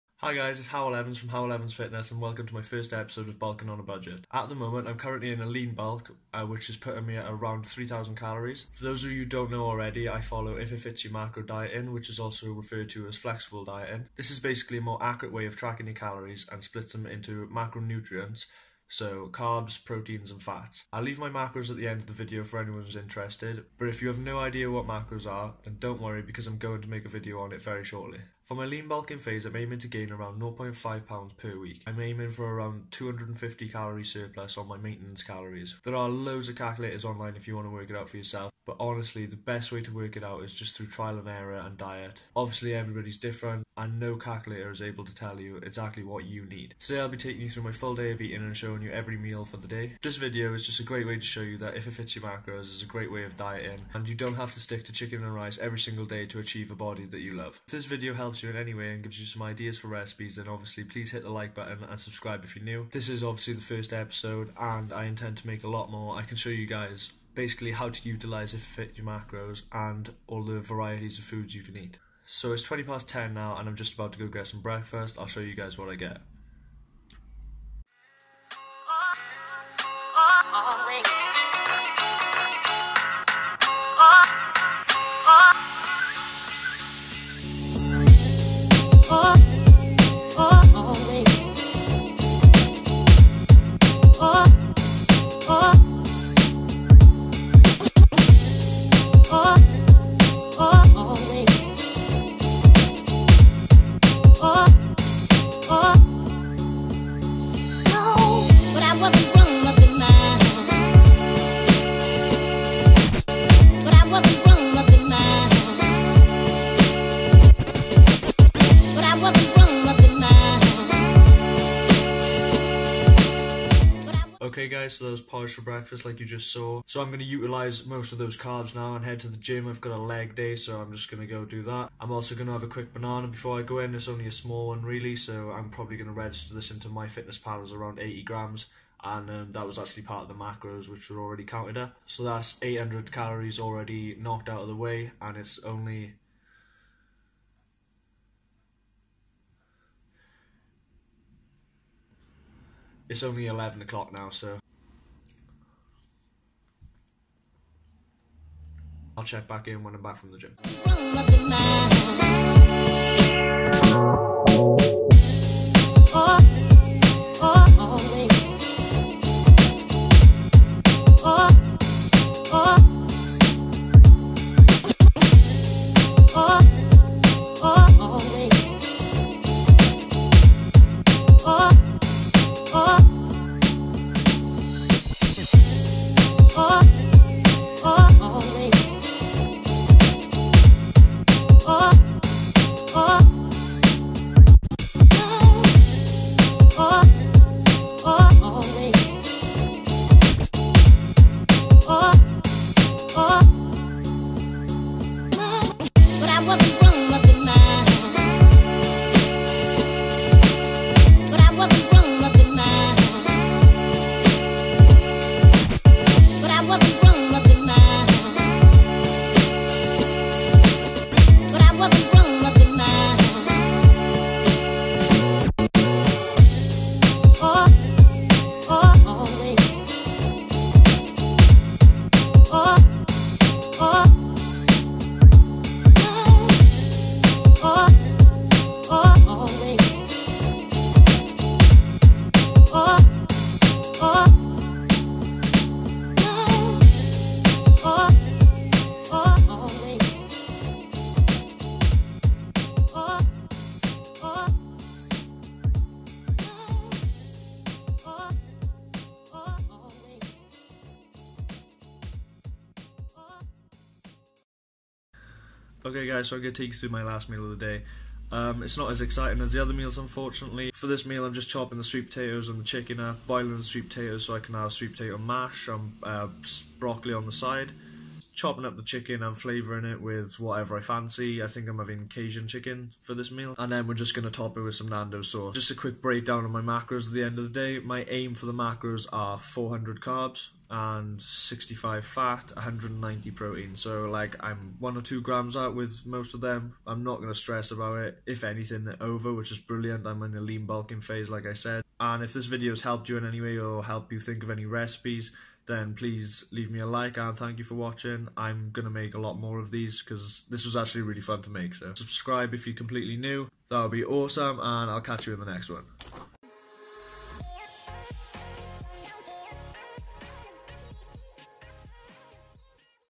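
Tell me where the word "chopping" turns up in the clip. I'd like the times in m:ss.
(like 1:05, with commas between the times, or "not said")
4:31, 4:38.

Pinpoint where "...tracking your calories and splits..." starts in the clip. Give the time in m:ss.
0:15.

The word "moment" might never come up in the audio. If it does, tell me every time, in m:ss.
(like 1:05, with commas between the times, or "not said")
0:04.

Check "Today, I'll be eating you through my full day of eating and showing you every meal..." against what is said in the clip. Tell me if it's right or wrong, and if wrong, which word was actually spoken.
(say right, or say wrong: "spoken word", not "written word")
wrong: "taking", not "eating".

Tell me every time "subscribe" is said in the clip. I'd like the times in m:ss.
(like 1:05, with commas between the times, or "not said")
1:01, 5:11.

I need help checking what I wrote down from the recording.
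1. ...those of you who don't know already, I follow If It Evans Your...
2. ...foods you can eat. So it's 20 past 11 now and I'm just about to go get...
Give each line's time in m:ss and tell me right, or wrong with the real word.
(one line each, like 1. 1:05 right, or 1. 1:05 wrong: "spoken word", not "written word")
1. 0:08 wrong: "Fits", not "Evans"
2. 1:11 wrong: "10", not "11".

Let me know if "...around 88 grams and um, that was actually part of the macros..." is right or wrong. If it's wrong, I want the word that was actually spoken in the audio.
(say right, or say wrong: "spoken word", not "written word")
wrong: "80", not "88".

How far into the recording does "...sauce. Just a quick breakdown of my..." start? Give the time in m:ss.
4:45.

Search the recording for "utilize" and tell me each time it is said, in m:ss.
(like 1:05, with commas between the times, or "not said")
1:08, 2:07.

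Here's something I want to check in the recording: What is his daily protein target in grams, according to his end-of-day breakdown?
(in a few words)
190.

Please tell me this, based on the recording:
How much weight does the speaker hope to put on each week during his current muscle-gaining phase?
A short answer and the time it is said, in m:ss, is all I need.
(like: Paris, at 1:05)
0.5 pounds, at 0:30.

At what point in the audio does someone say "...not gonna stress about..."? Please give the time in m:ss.
4:57.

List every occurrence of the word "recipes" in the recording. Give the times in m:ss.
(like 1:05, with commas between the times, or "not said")
0:59, 5:04.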